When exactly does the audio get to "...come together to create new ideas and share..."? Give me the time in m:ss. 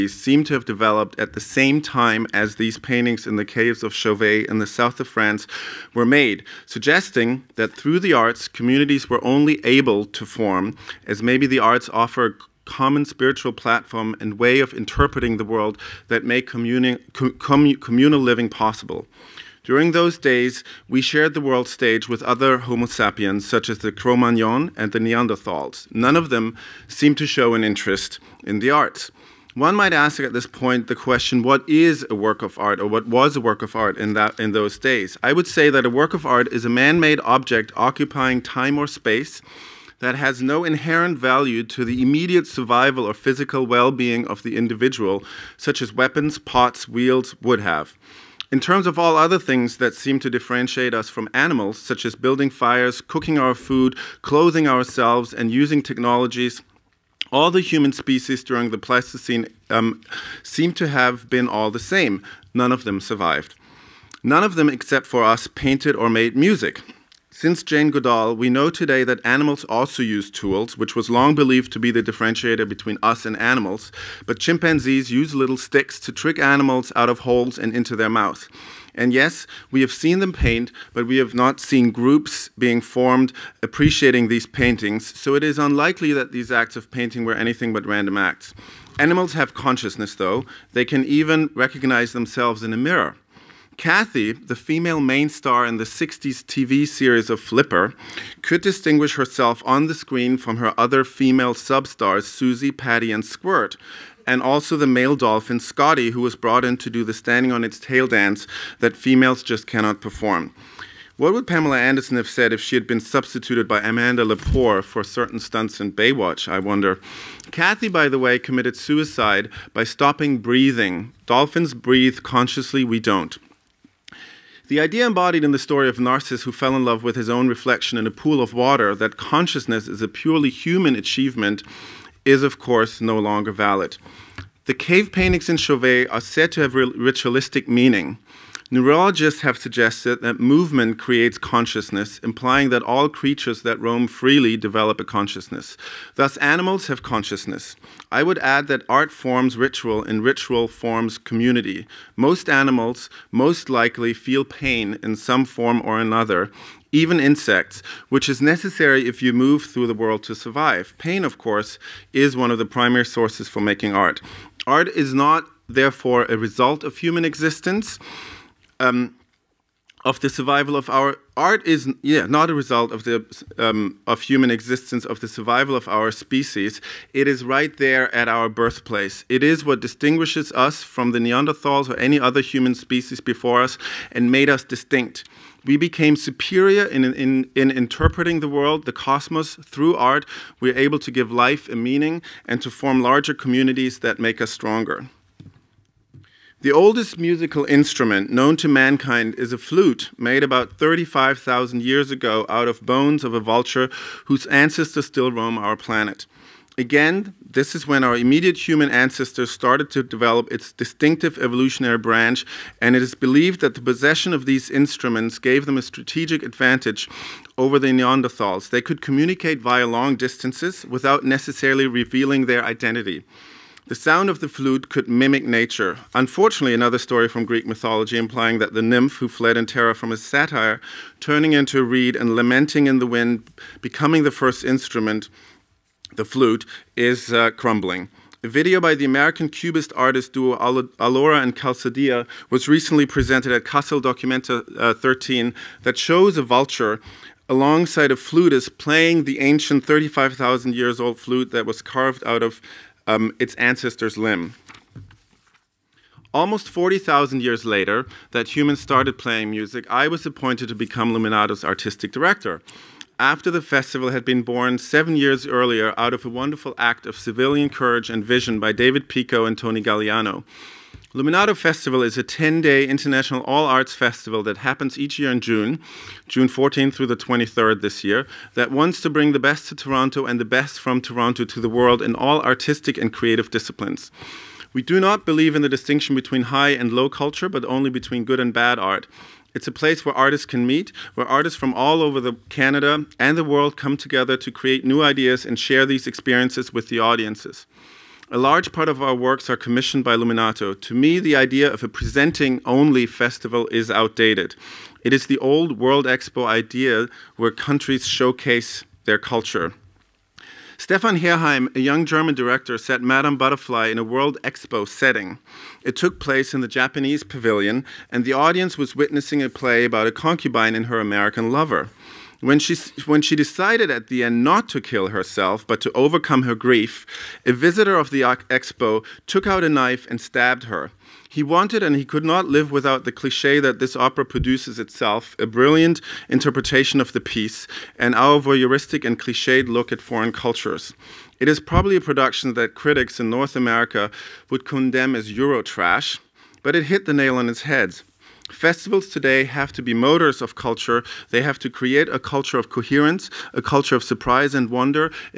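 4:53.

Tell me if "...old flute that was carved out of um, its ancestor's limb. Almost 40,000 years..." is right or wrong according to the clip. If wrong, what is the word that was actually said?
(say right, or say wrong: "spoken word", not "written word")
right.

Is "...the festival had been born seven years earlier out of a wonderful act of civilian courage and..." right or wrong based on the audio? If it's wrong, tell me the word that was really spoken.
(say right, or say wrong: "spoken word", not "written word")
right.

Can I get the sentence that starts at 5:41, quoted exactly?
It is probably a production that critics in North America would condemn as Eurotrash, but it hit the nail on its head.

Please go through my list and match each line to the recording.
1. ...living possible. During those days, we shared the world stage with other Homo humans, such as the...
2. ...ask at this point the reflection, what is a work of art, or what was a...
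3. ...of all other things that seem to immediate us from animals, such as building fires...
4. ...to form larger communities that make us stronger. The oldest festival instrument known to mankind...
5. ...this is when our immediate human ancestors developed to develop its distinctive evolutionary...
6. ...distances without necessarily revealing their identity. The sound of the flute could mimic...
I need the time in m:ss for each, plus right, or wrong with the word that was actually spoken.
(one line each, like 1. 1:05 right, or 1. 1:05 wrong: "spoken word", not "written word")
1. 0:18 wrong: "sapiens", not "humans"
2. 0:29 wrong: "question", not "reflection"
3. 0:48 wrong: "differentiate", not "immediate"
4. 3:12 wrong: "musical", not "festival"
5. 3:27 wrong: "started", not "developed"
6. 3:40 right.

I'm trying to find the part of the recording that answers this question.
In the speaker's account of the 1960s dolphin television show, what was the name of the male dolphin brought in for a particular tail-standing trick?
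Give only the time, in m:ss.
1:45.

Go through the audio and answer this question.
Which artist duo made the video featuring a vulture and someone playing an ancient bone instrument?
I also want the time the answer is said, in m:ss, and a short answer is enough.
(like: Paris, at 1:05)
Allora and Calzadilla, at 4:00.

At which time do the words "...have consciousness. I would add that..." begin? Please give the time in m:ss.
2:26.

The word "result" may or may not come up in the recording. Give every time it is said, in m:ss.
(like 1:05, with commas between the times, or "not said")
2:46, 2:52.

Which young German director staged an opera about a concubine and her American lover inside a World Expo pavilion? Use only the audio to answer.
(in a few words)
Stefan Herheim.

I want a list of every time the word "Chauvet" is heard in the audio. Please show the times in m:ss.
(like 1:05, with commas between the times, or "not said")
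0:03, 2:15.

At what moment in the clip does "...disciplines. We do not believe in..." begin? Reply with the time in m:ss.
4:43.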